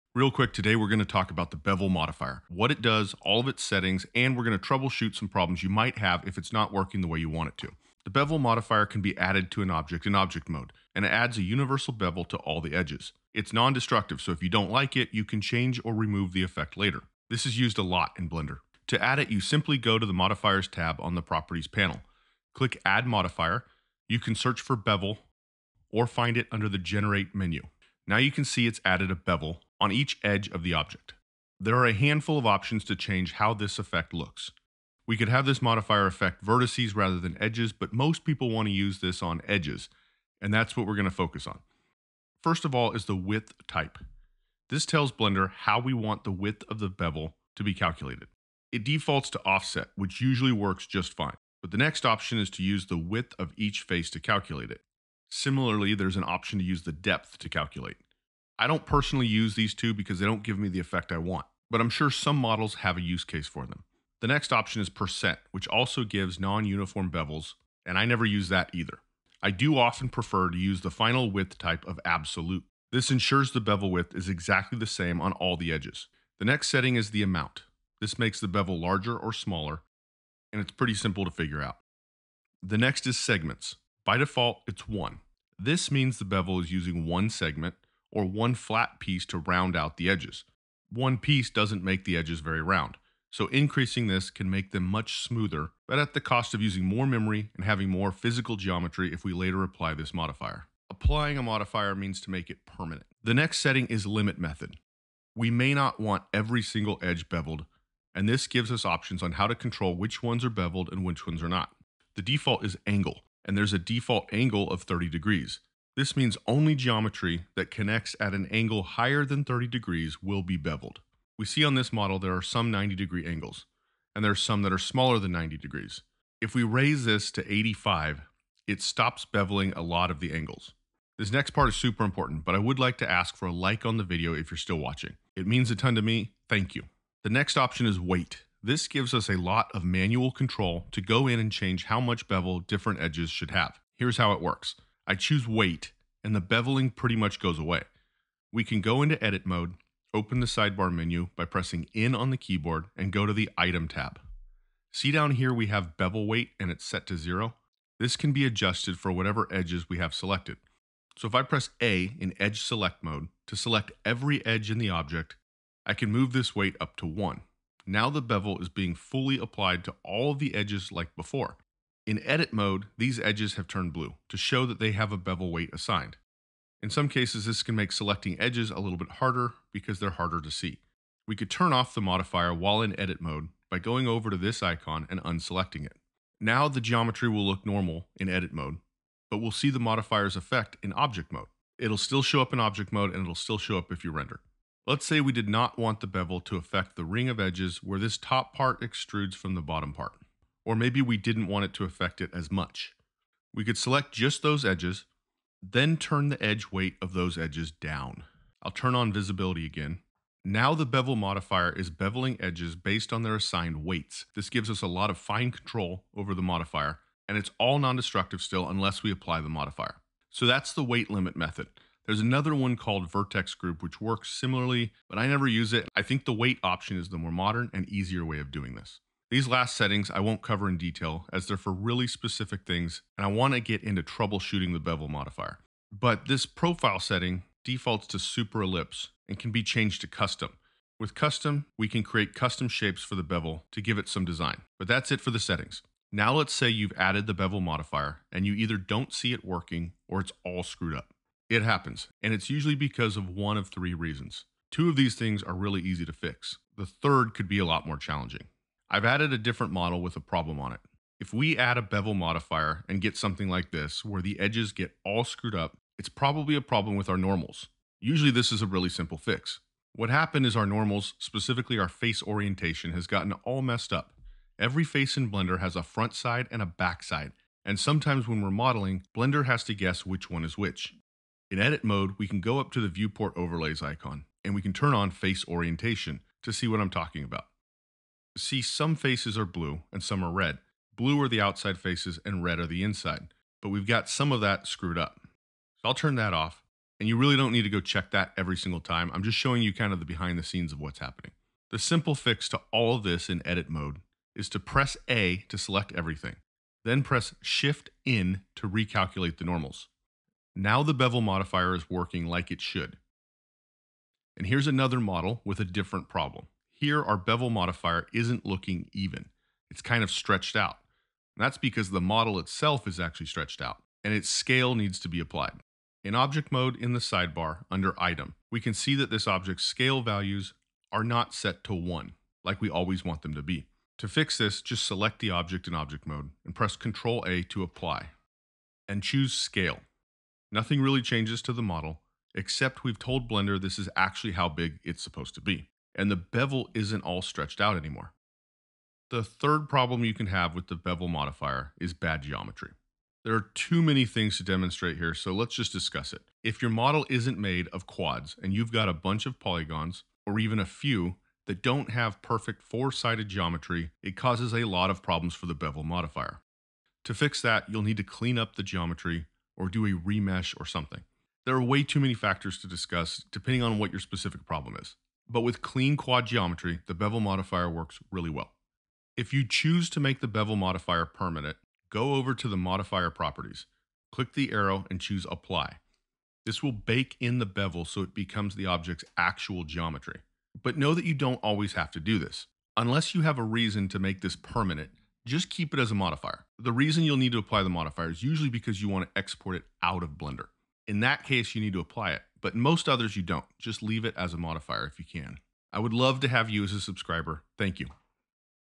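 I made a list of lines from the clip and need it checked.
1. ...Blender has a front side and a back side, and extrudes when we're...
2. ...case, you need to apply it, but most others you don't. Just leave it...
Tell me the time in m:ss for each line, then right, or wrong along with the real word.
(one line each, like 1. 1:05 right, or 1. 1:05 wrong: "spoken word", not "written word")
1. 4:35 wrong: "sometimes", not "extrudes"
2. 6:41 right.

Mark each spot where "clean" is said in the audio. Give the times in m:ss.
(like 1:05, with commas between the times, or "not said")
6:08, 6:15.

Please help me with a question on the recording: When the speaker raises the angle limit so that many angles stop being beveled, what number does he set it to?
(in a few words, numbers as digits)
85.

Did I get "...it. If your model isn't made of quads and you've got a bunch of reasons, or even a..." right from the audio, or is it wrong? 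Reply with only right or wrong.
wrong.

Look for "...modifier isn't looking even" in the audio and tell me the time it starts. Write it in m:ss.
5:17.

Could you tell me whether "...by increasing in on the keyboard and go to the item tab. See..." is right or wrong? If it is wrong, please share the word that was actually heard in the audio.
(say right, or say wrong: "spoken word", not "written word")
wrong: "pressing", not "increasing".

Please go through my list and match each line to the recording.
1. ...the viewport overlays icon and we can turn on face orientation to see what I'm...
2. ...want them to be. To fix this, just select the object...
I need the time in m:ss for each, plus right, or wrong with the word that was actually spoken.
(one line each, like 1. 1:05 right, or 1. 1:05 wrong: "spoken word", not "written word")
1. 4:42 right
2. 5:33 right.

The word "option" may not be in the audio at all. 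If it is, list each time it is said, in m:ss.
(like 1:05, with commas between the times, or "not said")
0:32, 0:52, 0:56, 1:04, 1:48, 2:17, 3:46.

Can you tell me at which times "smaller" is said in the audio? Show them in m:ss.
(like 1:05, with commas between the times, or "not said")
1:19, 2:04.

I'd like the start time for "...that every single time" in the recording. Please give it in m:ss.
4:58.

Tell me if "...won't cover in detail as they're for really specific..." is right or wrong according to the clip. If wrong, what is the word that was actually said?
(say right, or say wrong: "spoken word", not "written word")
right.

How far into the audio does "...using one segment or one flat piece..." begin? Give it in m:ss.
1:26.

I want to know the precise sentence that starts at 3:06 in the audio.
Now the geometry will look normal in edit mode, but we'll see the modifier's effect in object mode.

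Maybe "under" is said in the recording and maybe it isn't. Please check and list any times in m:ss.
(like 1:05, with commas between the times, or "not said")
0:26, 5:27.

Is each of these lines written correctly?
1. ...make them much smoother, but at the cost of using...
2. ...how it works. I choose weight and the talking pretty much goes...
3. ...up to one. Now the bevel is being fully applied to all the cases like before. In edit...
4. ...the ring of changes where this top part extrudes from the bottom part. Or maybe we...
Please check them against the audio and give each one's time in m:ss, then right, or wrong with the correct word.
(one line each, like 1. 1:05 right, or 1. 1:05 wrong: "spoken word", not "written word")
1. 1:34 right
2. 2:24 wrong: "beveling", not "talking"
3. 2:46 wrong: "edges", not "cases"
4. 3:16 wrong: "edges", not "changes".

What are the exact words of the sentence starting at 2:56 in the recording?
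In some cases, this can make selecting edges a little bit harder because they're harder to see.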